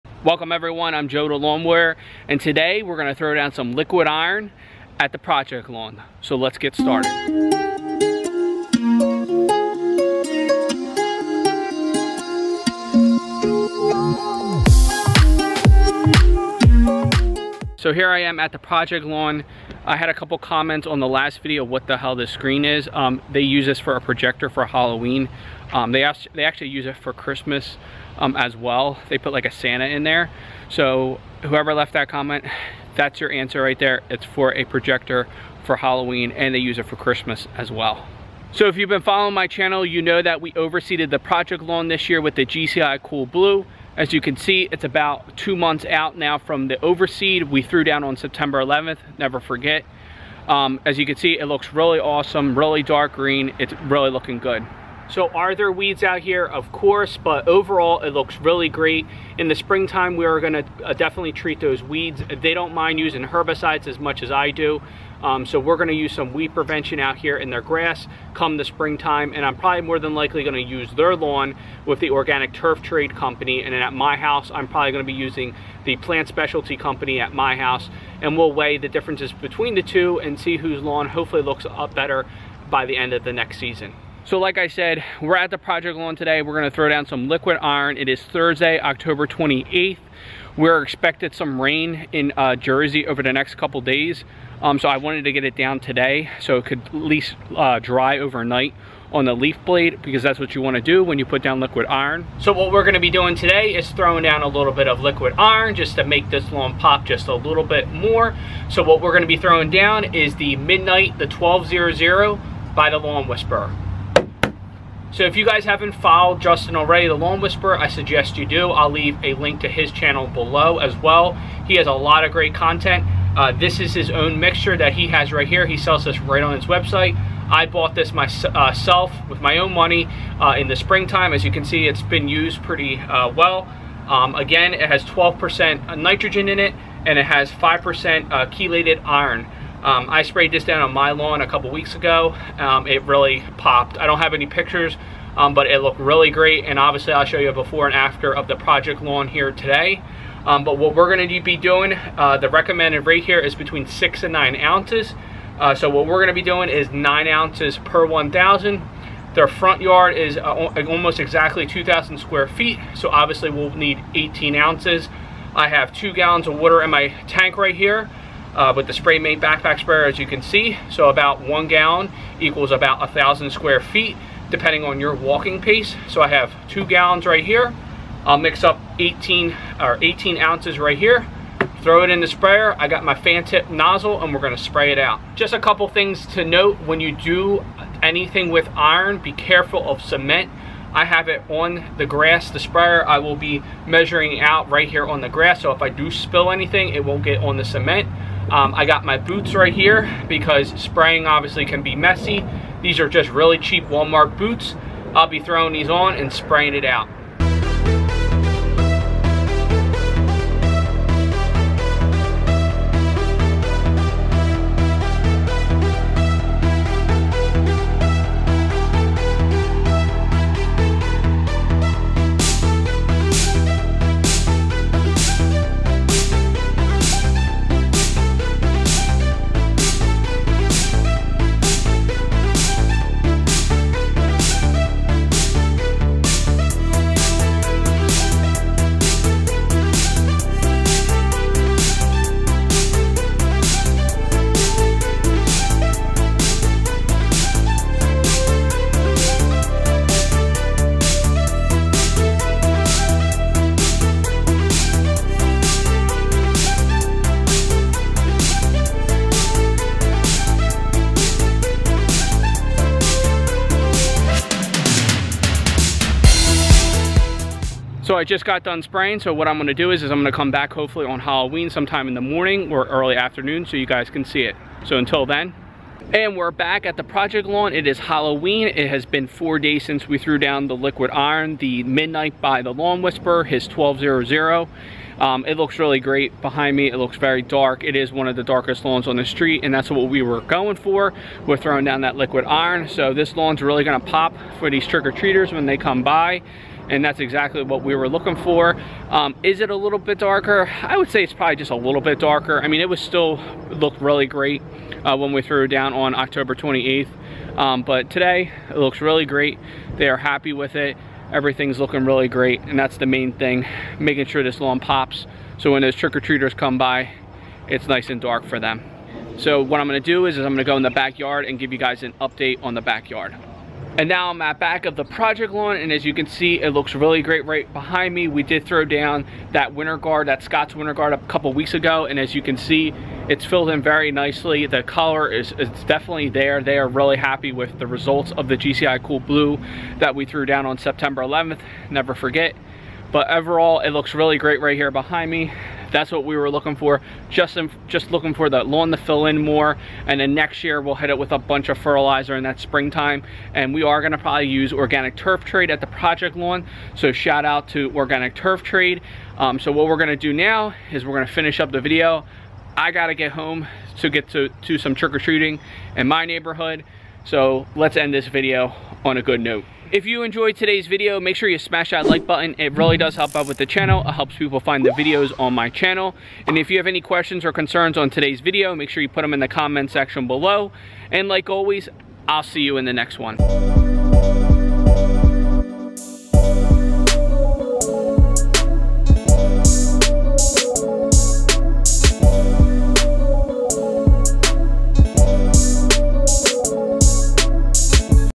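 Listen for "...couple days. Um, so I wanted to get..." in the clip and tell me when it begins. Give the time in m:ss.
1:33.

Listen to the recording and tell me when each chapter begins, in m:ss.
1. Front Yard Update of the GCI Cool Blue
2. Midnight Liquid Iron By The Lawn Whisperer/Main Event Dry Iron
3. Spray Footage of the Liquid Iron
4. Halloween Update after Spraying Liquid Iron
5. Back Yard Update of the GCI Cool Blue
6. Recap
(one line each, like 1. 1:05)
1. 0:38
2. 1:24
3. 3:27
4. 4:27
5. 5:19
6. 6:09.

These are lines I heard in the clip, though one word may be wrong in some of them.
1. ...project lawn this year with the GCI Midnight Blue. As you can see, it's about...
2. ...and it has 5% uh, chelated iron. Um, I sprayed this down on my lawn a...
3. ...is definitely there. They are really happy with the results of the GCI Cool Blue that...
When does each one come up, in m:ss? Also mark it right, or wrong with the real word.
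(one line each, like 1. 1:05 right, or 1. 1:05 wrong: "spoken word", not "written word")
1. 0:41 wrong: "Cool", not "Midnight"
2. 2:17 right
3. 5:35 right.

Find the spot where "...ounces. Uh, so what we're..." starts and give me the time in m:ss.
2:34.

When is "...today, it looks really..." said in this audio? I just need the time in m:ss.
5:08.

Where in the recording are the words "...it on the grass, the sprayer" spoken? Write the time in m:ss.
3:11.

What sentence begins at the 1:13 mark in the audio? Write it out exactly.
And then at my house, I'm probably gonna be using the plant specialty company at my house.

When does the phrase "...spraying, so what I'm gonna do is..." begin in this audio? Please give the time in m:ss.
4:28.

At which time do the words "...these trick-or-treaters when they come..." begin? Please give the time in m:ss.
4:54.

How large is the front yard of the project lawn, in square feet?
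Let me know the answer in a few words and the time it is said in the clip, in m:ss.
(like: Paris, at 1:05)
2,000, at 2:41.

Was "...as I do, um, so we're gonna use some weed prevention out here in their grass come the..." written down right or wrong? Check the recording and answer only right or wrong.
right.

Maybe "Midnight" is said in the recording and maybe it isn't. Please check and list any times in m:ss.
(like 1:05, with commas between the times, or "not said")
1:50, 4:41.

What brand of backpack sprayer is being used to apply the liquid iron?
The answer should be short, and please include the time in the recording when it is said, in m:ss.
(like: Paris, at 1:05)
Spray Main, at 2:48.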